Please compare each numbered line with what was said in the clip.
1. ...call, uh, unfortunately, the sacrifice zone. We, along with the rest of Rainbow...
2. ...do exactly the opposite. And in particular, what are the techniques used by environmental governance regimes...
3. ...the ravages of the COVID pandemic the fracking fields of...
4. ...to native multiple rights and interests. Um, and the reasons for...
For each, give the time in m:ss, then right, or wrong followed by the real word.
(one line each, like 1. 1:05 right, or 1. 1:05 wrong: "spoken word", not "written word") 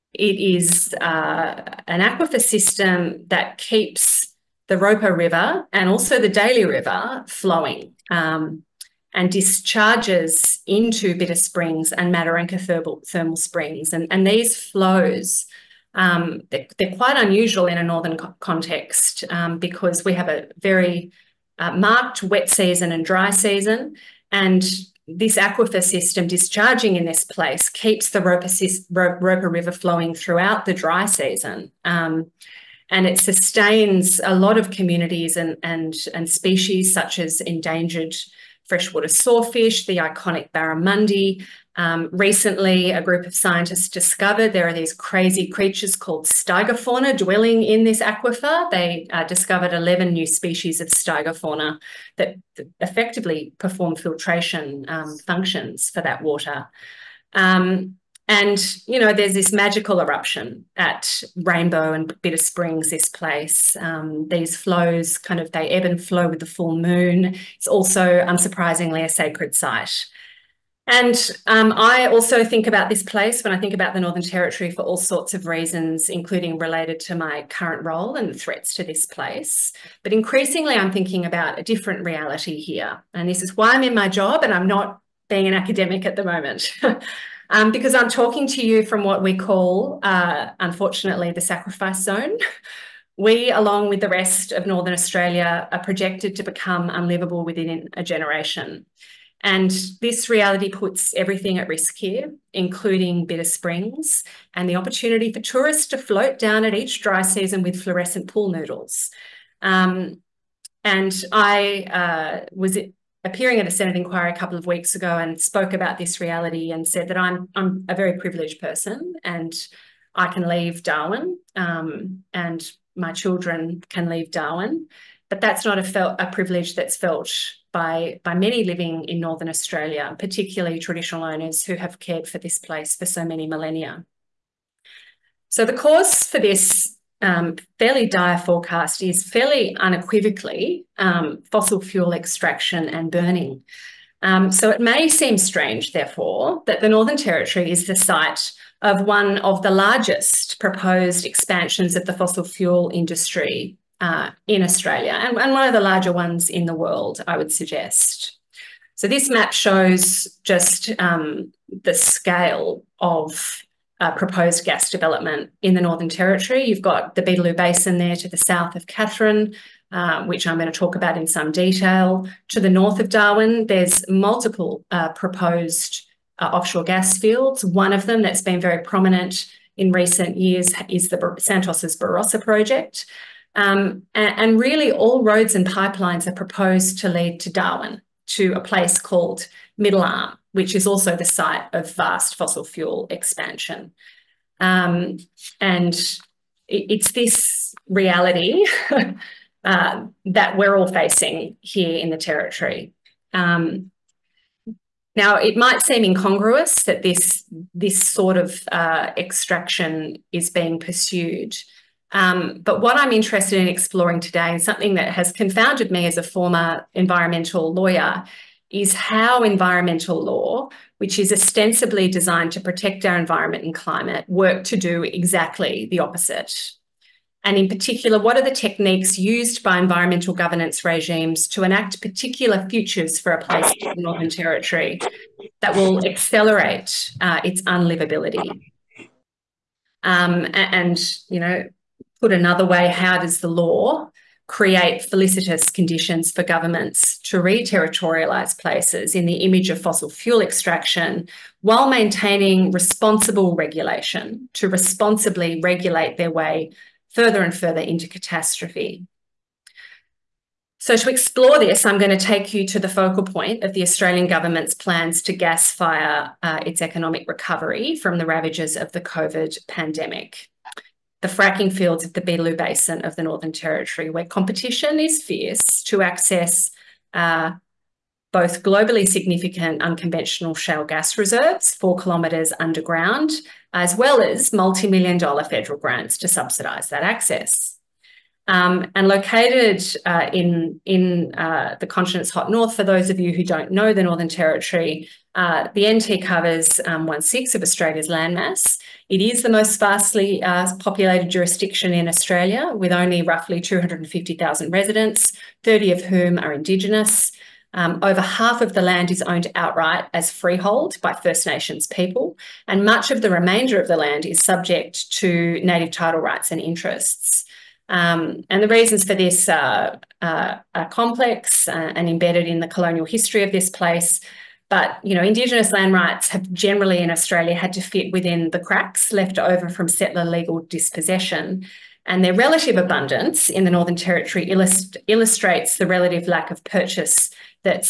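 1. 1:29 wrong: "Northern", not "Rainbow"
2. 3:44 right
3. 4:28 right
4. 5:15 wrong: "title", not "multiple".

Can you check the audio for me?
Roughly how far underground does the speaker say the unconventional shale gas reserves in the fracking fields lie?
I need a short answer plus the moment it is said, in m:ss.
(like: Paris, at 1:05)
4 kilometres, at 4:41.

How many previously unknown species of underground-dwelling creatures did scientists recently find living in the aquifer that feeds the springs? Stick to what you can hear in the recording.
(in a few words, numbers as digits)
11.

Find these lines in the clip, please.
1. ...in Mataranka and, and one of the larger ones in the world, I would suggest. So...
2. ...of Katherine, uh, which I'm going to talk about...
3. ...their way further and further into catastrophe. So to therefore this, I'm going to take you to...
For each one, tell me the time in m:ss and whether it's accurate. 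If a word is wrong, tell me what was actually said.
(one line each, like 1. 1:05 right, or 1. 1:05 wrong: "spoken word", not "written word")
1. 2:34 wrong: "Australia", not "Mataranka"
2. 2:48 right
3. 4:16 wrong: "explore", not "therefore".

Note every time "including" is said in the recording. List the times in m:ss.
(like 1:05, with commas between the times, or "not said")
1:16, 1:42.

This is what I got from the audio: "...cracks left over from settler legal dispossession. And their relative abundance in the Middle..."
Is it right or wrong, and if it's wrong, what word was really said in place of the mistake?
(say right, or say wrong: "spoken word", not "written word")
wrong: "Northern", not "Middle".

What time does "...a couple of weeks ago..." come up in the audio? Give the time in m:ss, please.
1:54.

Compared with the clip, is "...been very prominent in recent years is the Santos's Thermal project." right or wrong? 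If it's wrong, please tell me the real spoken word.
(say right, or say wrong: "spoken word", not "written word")
wrong: "Barossa", not "Thermal".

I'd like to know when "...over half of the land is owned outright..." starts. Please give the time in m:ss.
5:08.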